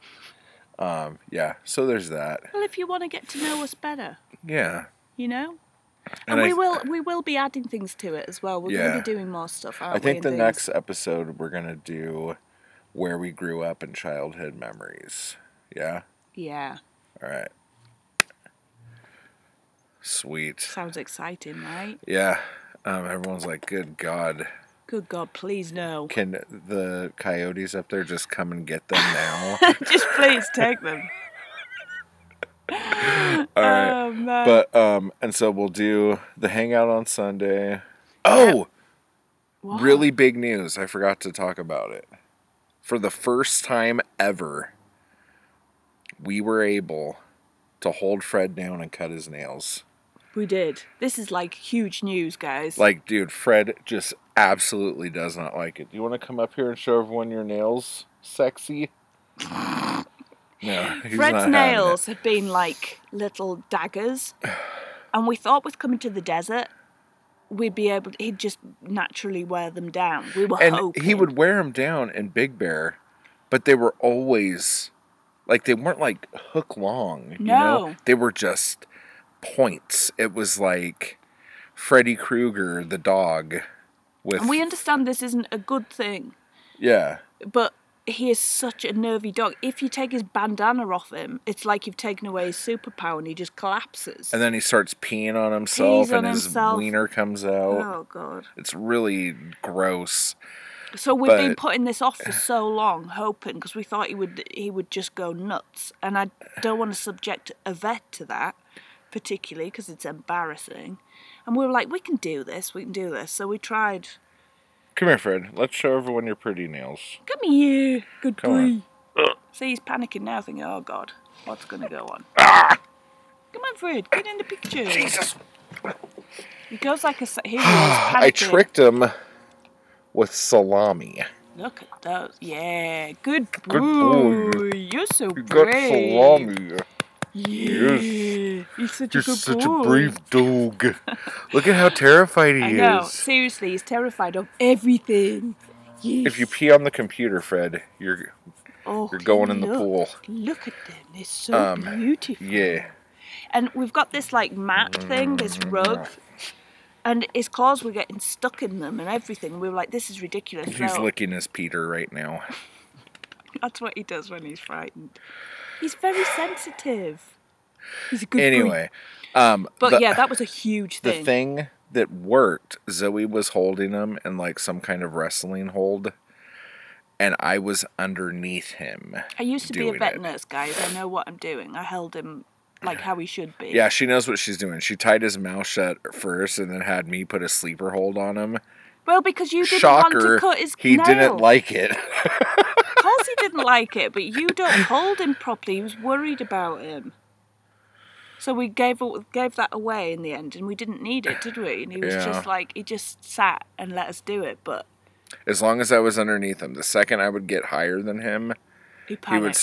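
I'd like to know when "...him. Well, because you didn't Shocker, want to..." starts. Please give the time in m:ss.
3:08.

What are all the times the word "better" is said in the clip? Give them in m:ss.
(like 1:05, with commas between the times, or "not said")
0:03.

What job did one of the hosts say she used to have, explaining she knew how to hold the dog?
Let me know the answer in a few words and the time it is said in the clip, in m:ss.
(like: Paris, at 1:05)
Vet nurse, at 2:59.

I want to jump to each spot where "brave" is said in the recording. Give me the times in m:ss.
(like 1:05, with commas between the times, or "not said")
2:15, 2:19.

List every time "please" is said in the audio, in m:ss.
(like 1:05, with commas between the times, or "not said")
0:25, 0:30.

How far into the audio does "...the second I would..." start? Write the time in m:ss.
3:26.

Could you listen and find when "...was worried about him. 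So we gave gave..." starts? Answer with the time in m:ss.
3:15.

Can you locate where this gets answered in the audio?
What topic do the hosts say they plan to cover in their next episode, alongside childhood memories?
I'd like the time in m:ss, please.
0:12.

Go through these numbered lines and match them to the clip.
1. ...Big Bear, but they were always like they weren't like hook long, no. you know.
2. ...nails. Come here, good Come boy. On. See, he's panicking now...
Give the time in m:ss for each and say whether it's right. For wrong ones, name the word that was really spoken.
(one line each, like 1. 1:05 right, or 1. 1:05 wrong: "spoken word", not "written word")
1. 1:12 right
2. 1:56 right.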